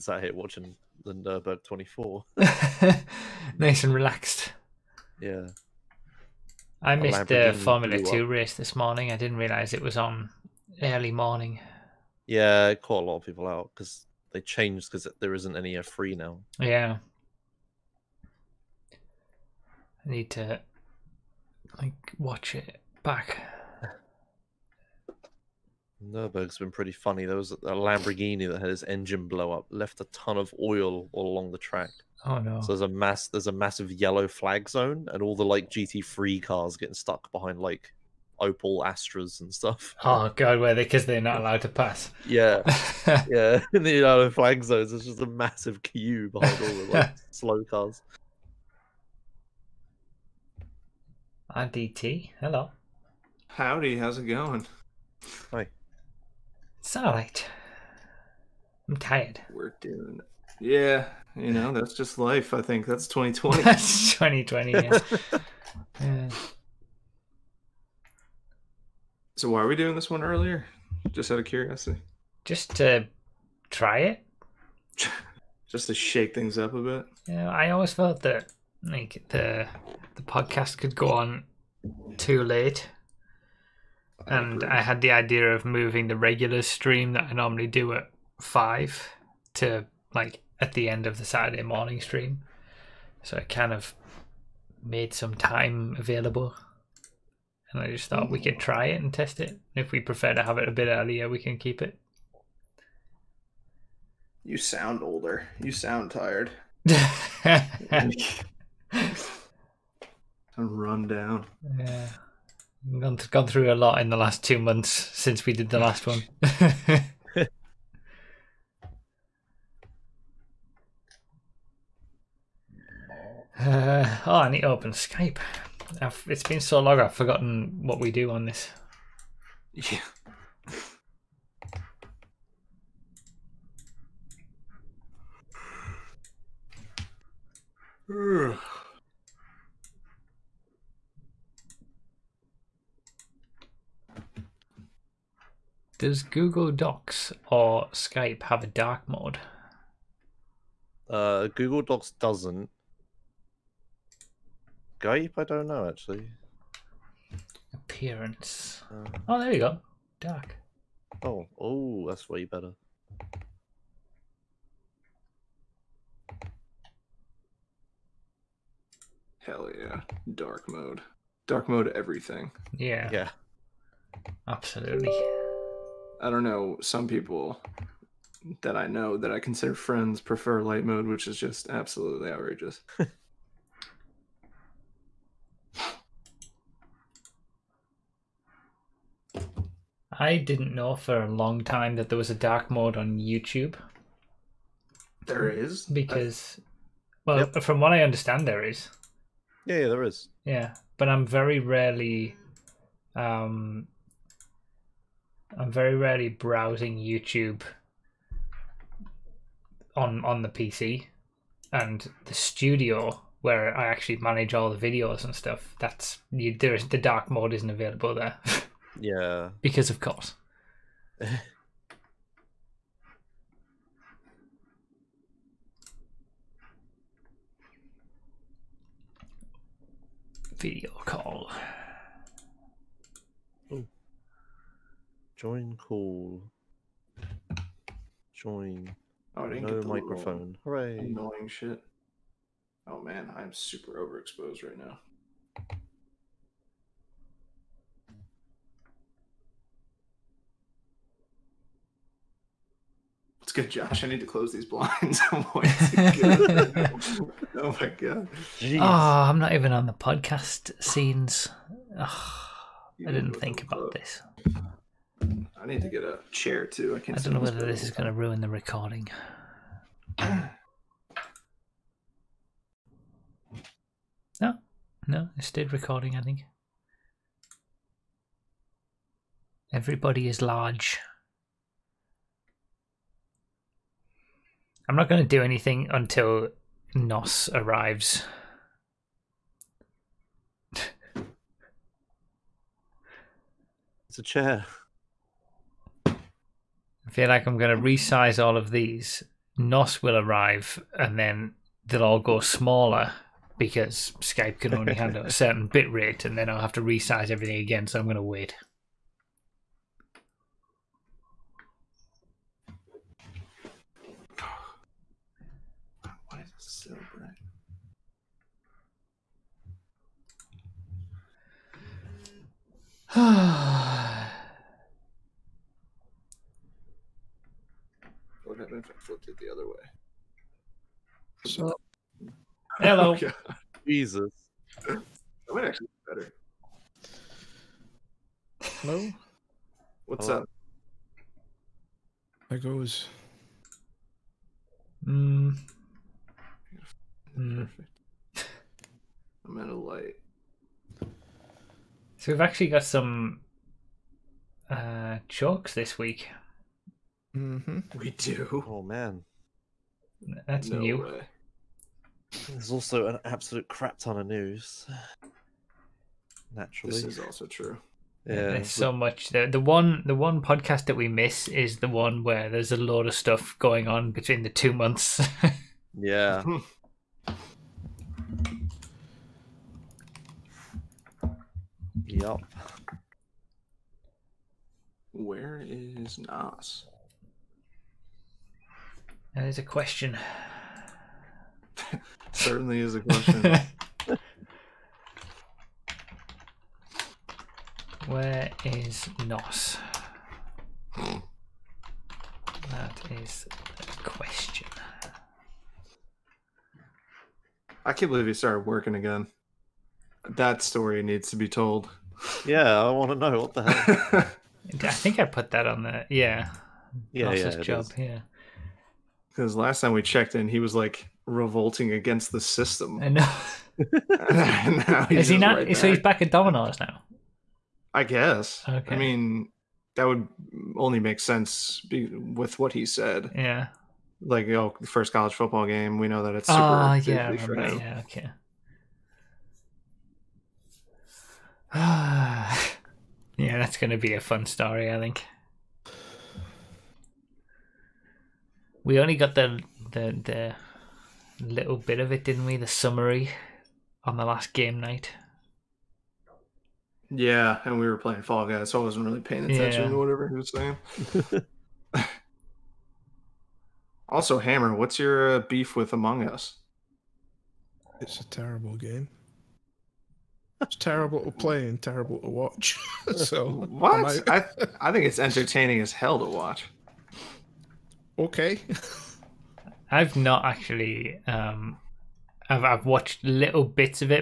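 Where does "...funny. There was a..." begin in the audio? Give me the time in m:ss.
0:26.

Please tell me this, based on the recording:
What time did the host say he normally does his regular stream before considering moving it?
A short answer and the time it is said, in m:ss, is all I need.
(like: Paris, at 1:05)
5, at 1:28.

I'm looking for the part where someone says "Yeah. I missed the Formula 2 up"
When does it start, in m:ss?
0:05.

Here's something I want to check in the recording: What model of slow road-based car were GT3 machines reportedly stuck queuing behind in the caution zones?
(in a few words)
Opel Astras.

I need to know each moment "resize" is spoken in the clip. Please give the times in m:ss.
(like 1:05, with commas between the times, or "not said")
4:57, 5:06.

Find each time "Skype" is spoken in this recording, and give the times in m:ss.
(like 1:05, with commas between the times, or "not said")
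2:04, 2:27, 2:34, 5:04.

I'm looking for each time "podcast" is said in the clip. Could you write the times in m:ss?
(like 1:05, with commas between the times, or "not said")
1:20, 4:19, 6:10.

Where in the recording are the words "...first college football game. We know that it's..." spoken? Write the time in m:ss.
7:14.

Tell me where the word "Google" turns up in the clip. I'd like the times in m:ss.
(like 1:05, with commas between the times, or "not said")
2:26, 2:31.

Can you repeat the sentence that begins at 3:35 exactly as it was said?
That's you, there is the dark mode isn't available there.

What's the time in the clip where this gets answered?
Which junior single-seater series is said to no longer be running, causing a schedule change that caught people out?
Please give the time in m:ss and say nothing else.
0:15.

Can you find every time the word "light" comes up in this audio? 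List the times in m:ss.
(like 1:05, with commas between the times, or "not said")
3:00, 5:49.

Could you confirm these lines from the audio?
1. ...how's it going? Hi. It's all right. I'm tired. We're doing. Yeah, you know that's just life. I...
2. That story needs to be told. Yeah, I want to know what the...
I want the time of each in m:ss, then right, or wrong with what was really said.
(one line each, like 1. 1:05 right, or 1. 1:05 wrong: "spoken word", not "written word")
1. 0:53 right
2. 6:50 right.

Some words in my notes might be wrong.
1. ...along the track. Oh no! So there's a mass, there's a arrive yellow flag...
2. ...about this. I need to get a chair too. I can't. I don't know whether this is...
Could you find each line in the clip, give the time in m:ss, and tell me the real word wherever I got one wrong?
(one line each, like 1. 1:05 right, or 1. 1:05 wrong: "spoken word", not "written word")
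1. 0:31 wrong: "massive", not "arrive"
2. 4:23 right.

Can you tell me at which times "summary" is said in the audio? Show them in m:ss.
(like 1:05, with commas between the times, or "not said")
7:32.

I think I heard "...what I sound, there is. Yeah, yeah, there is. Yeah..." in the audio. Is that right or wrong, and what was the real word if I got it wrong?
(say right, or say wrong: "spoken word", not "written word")
wrong: "understand", not "sound".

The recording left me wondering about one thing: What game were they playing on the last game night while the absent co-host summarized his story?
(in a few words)
Fall Guys.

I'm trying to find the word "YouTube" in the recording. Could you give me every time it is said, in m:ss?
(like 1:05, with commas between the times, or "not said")
3:13, 3:26.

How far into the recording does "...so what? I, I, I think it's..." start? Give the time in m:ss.
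7:53.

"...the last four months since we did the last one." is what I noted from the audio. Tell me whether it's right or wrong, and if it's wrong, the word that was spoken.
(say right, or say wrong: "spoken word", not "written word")
wrong: "two", not "four".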